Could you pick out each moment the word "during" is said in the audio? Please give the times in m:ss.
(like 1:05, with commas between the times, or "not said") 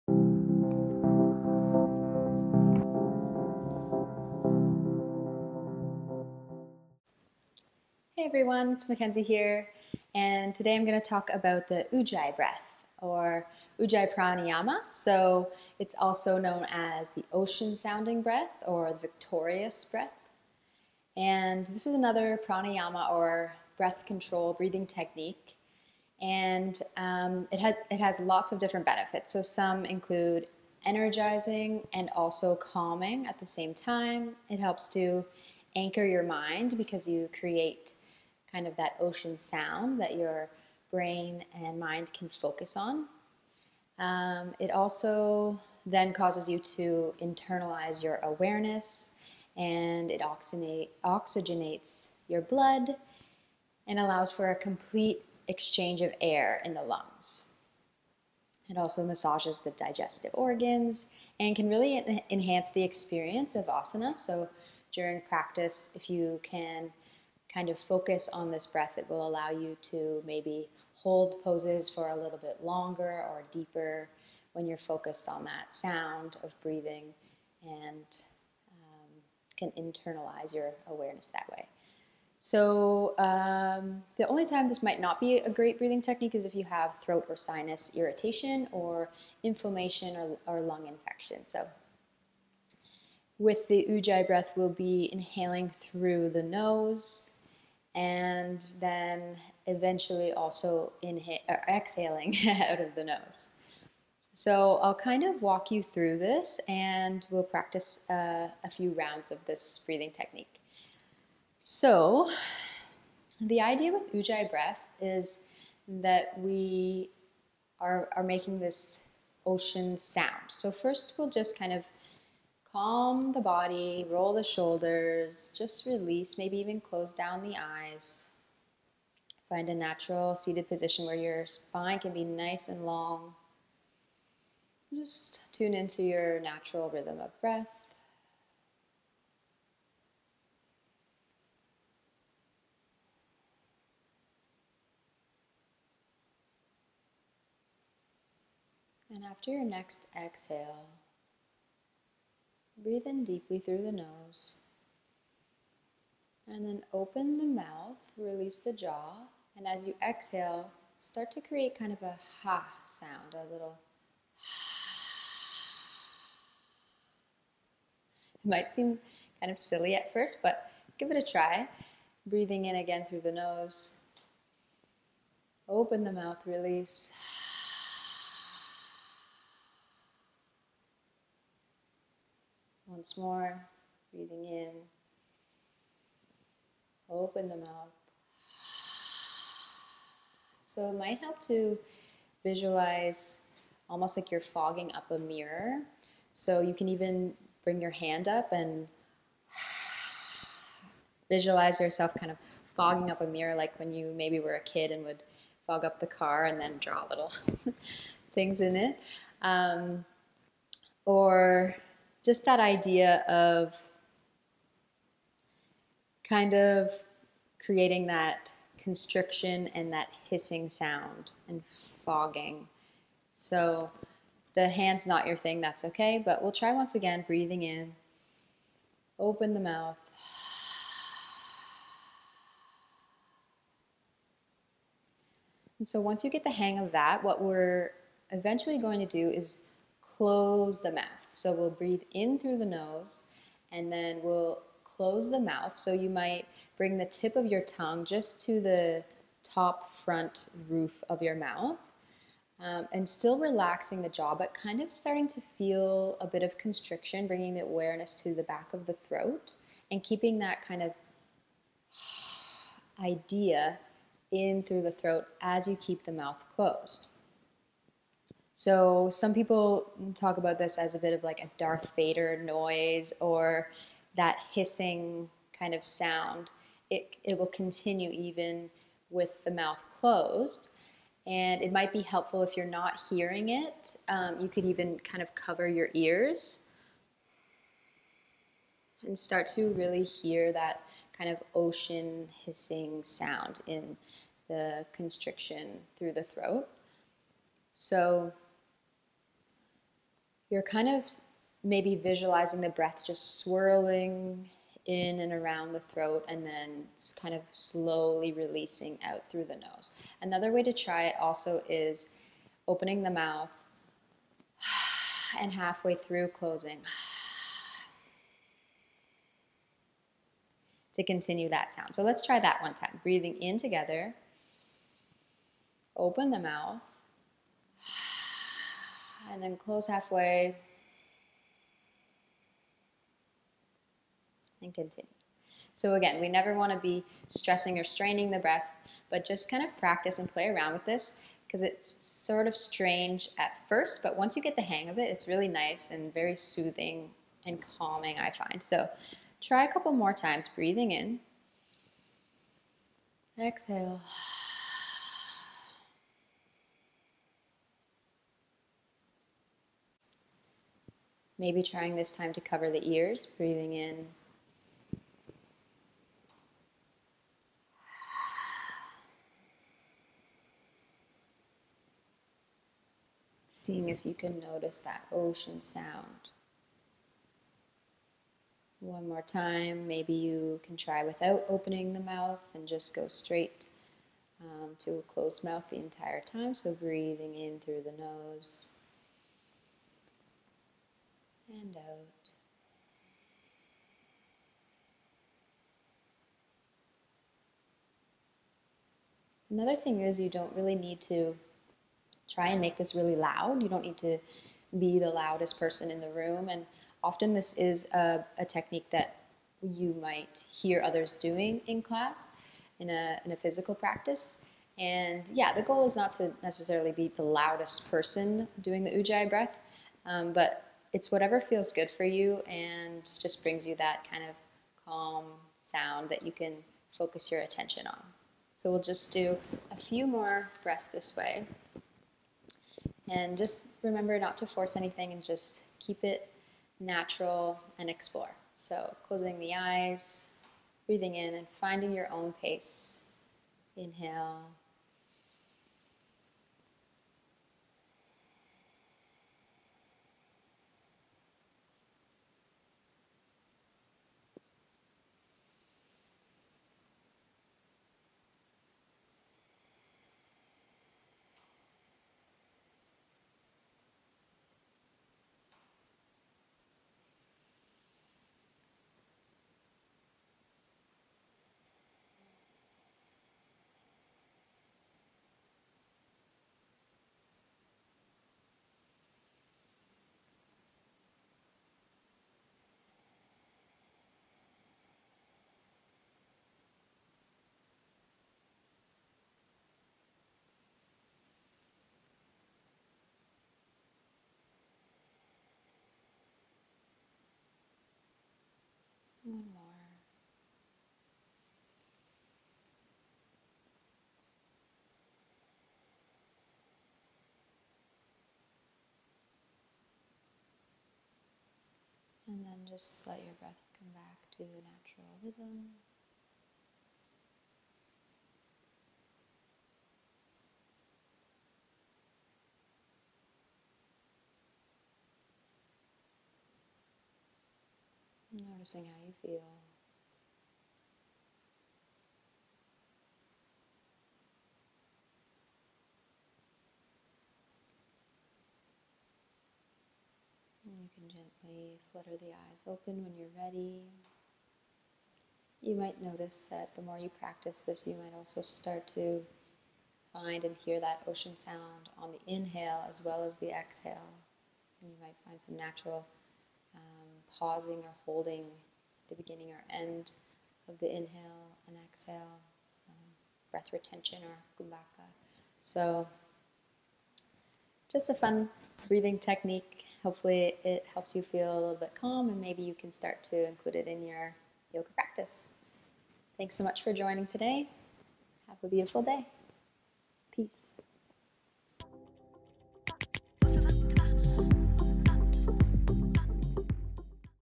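1:04.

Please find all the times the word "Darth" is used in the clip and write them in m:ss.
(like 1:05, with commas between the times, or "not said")
4:31.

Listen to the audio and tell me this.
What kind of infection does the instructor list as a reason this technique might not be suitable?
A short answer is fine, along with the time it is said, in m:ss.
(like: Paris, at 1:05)
lung infection, at 1:30.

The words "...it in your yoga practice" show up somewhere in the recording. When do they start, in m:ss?
9:33.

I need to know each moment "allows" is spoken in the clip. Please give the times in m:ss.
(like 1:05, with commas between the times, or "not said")
0:53, 1:09.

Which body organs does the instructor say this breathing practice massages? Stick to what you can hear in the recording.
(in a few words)
digestive organs.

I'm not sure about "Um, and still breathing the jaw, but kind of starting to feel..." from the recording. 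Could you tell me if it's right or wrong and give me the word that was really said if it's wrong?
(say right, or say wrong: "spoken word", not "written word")
wrong: "relaxing", not "breathing".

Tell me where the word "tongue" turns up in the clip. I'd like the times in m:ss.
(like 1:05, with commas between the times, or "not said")
4:07.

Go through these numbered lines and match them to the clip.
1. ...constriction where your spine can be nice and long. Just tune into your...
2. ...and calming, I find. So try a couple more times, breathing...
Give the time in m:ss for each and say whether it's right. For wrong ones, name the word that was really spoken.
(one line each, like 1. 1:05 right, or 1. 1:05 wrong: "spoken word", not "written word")
1. 2:10 wrong: "position", not "constriction"
2. 5:47 right.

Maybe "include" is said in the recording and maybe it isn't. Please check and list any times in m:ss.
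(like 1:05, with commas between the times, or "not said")
0:29, 9:33.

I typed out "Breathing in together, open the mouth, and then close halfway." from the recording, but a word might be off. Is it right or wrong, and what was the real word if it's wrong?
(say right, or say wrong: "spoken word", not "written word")
right.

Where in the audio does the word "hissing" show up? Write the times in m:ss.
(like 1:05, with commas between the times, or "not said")
3:40, 4:34, 4:52.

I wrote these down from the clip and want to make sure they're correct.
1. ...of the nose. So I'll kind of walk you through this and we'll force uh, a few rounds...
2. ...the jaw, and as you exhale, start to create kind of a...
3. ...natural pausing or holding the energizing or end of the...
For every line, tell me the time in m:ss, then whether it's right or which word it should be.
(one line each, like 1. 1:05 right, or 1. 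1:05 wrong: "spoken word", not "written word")
1. 1:42 wrong: "practice", not "force"
2. 2:38 right
3. 9:15 wrong: "beginning", not "energizing".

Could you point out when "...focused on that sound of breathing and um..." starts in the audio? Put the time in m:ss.
1:14.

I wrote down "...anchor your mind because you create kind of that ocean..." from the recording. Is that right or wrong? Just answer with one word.
right.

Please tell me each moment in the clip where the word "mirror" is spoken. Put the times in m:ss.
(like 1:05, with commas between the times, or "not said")
3:15, 3:23.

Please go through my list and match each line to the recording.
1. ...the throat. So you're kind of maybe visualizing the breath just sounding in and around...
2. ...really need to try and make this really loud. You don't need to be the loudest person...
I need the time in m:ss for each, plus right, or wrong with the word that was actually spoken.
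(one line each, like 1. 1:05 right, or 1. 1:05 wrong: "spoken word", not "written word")
1. 4:56 wrong: "swirling", not "sounding"
2. 6:40 right.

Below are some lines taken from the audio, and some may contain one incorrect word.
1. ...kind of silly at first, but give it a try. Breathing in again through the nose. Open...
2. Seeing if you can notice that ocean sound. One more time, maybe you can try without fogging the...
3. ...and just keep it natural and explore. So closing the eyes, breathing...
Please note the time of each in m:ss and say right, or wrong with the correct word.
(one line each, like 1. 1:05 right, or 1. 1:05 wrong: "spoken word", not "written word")
1. 2:49 right
2. 6:13 wrong: "opening", not "fogging"
3. 7:15 right.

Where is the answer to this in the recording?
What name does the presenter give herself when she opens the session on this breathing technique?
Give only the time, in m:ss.
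0:08.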